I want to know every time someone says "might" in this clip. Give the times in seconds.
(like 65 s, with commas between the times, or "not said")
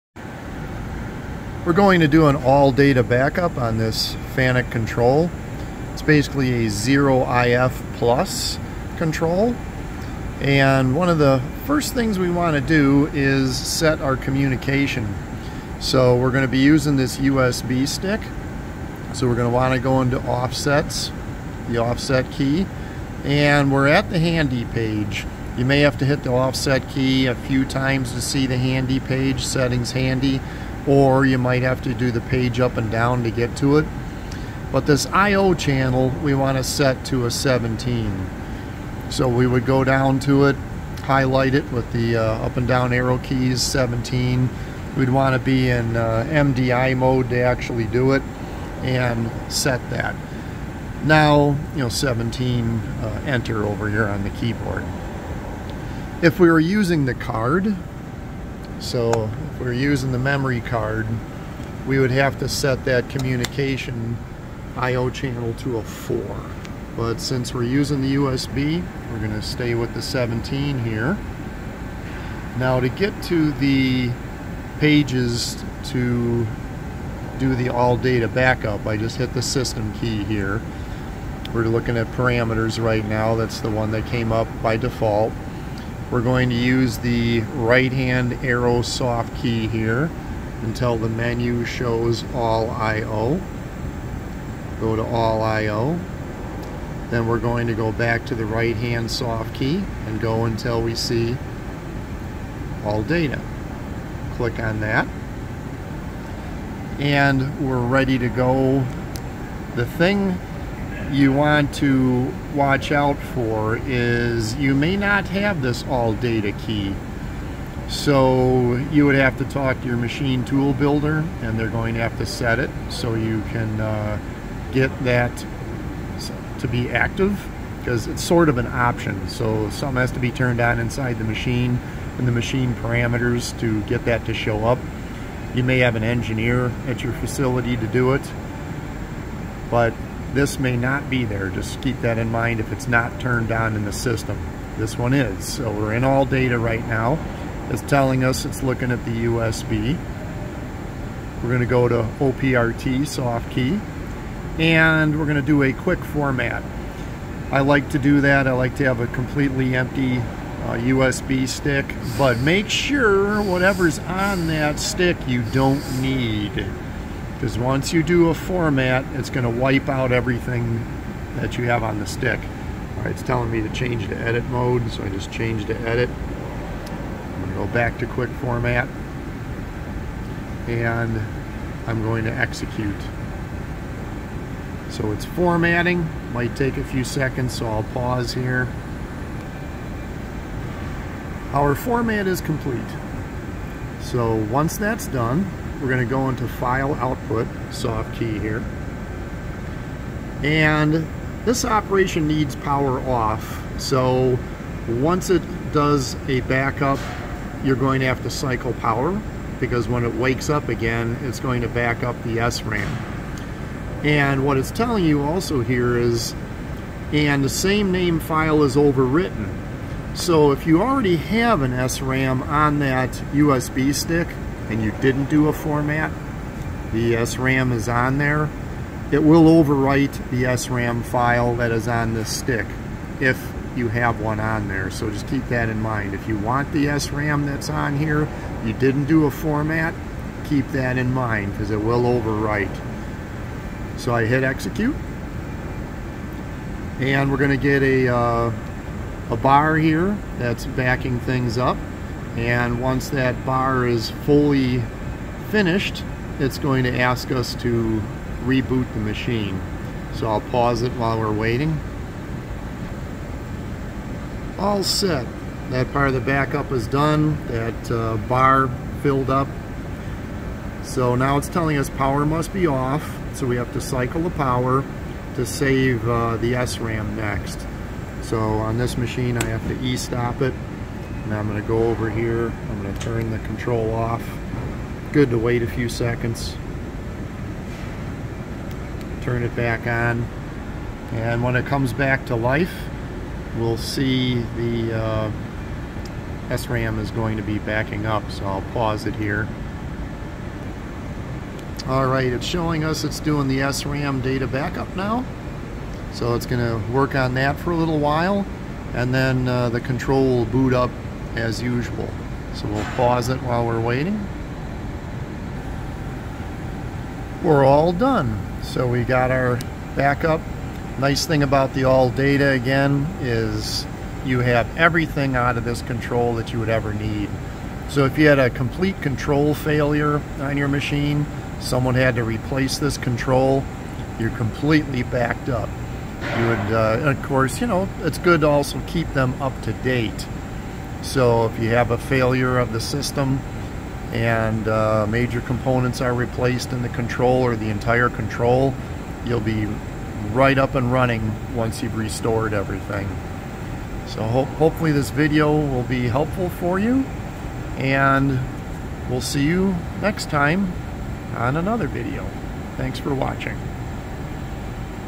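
31 s, 186 s.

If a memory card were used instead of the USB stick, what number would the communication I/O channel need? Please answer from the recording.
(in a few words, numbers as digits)
4.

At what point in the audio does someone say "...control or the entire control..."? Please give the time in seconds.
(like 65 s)
346 s.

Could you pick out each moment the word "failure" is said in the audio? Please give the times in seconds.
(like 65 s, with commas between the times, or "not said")
329 s, 341 s.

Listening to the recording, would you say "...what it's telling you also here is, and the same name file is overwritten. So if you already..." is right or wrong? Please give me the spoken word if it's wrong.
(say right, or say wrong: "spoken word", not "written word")
right.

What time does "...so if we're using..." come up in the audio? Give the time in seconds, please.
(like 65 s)
58 s.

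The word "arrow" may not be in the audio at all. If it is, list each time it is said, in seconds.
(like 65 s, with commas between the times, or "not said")
42 s, 88 s.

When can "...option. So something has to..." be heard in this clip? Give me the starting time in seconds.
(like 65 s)
128 s.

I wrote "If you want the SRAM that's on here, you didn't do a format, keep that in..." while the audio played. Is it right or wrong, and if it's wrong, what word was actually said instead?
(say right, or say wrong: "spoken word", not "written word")
right.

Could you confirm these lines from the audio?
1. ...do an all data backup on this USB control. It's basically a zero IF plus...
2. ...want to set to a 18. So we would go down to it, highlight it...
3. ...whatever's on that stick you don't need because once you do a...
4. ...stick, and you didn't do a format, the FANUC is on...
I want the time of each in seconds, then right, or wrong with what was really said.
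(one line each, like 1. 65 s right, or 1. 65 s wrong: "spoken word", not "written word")
1. 2 s wrong: "FANUC", not "USB"
2. 36 s wrong: "17", not "18"
3. 163 s right
4. 223 s wrong: "SRAM", not "FANUC".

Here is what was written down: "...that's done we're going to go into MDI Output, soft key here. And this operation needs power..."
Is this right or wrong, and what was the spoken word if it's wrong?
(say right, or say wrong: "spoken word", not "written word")
wrong: "File", not "MDI".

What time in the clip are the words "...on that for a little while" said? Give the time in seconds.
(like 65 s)
307 s.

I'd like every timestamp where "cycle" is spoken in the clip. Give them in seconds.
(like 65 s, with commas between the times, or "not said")
208 s, 273 s.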